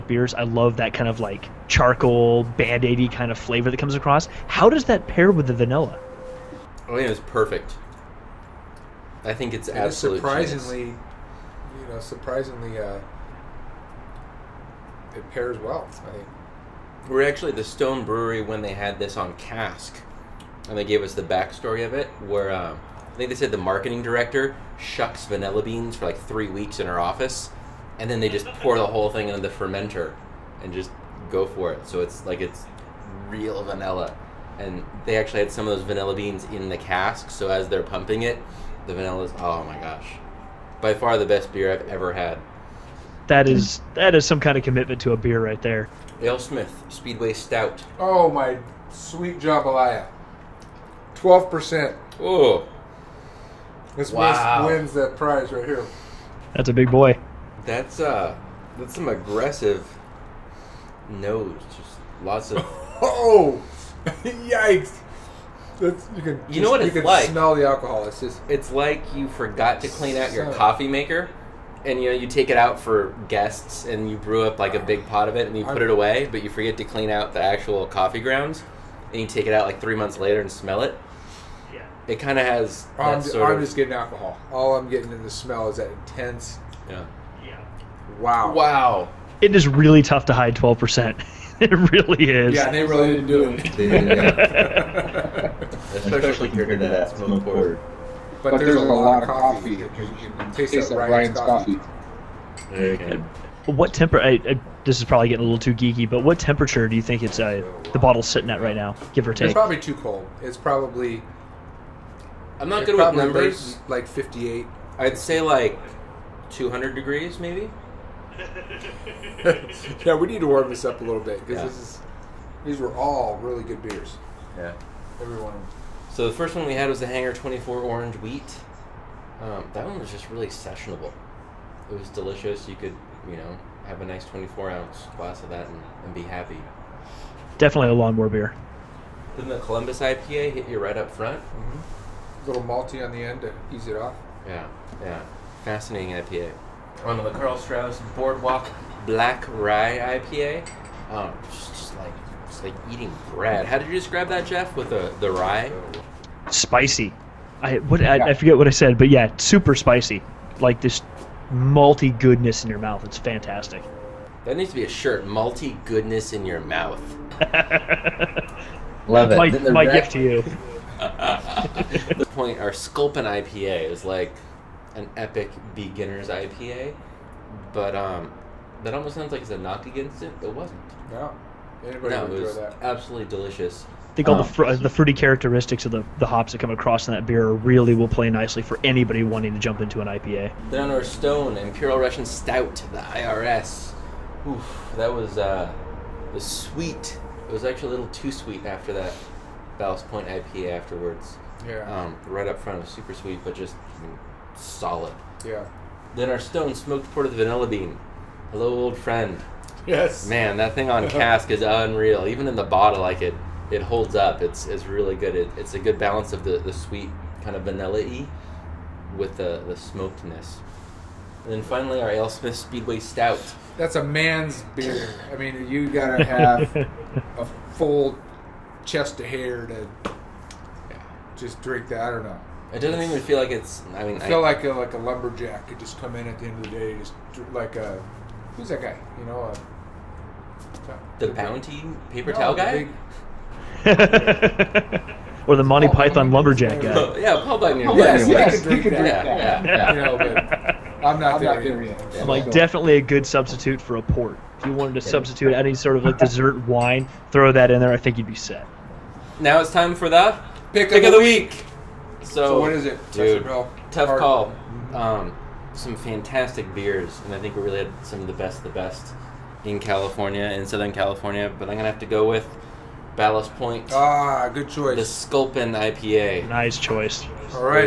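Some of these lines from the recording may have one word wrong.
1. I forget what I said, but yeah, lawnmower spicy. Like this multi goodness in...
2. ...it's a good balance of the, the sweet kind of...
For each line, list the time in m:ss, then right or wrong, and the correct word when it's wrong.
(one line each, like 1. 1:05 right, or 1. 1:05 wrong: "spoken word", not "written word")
1. 2:38 wrong: "super", not "lawnmower"
2. 3:35 right.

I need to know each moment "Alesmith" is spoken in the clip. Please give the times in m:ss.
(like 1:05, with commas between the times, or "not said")
0:46, 3:42.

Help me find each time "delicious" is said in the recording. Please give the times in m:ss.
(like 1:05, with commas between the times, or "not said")
2:12, 3:03.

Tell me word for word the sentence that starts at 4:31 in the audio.
But I'm gonna have to go with Ballast Point.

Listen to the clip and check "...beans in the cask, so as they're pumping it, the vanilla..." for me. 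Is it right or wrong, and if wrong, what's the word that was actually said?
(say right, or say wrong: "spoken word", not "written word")
right.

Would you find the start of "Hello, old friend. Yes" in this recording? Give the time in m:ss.
3:28.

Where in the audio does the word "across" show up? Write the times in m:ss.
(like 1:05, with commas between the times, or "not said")
0:03, 3:06.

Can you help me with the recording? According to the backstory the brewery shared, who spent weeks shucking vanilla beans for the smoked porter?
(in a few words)
The marketing director.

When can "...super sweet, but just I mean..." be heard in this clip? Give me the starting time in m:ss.
3:22.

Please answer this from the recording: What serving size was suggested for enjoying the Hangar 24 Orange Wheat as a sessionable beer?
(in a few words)
24 ounces.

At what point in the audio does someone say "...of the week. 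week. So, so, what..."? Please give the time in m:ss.
4:21.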